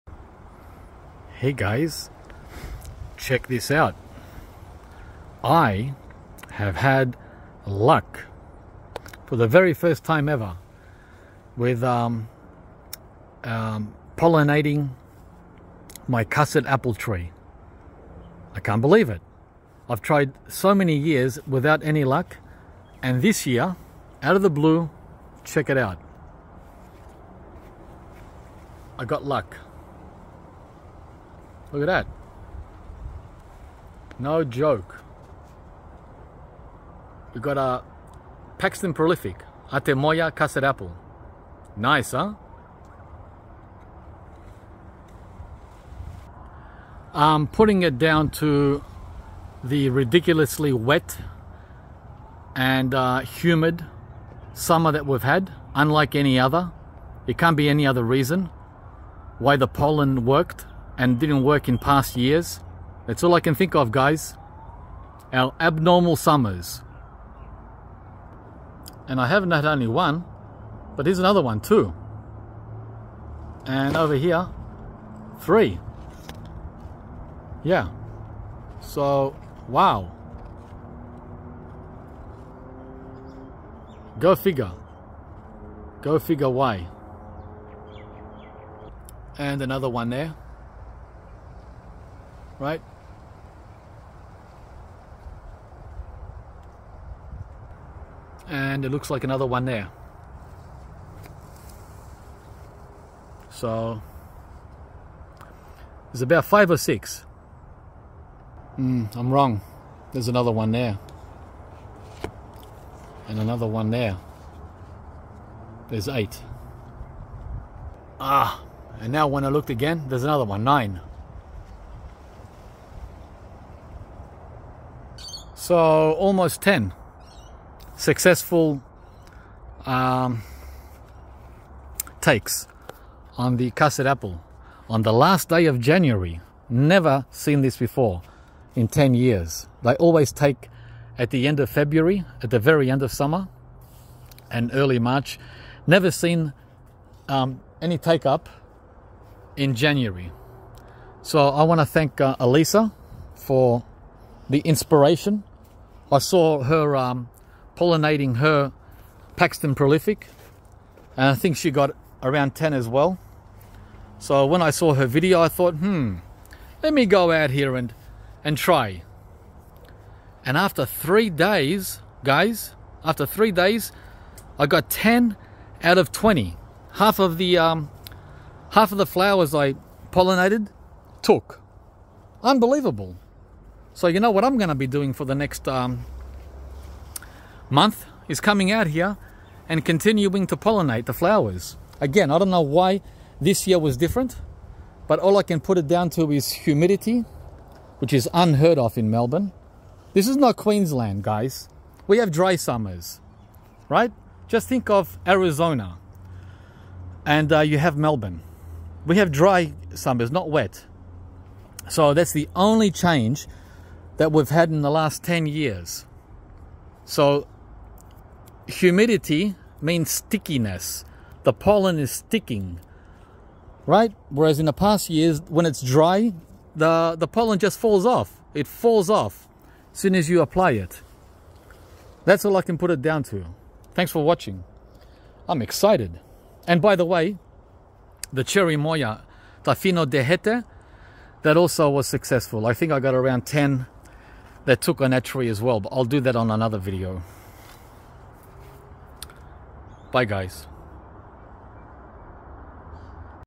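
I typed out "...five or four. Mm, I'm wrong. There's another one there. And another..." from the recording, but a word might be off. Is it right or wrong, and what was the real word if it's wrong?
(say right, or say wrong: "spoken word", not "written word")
wrong: "six", not "four".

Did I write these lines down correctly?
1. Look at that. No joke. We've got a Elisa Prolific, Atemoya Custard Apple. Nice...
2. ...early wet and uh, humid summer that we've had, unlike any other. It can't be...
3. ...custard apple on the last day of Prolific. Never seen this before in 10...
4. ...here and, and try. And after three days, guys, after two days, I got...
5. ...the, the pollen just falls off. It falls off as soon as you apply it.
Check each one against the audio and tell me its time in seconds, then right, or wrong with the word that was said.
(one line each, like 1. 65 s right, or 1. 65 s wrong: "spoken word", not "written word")
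1. 31 s wrong: "Paxton", not "Elisa"
2. 49 s wrong: "ridiculously", not "early"
3. 133 s wrong: "January", not "Prolific"
4. 167 s wrong: "three", not "two"
5. 226 s right.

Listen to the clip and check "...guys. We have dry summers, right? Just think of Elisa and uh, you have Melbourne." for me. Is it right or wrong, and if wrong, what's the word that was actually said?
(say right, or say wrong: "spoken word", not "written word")
wrong: "Arizona", not "Elisa".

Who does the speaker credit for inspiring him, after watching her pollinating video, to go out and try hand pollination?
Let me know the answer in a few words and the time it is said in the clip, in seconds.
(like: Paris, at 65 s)
Elisa, at 152 s.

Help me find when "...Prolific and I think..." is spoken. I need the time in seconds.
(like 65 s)
159 s.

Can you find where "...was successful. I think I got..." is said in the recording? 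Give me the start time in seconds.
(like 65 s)
241 s.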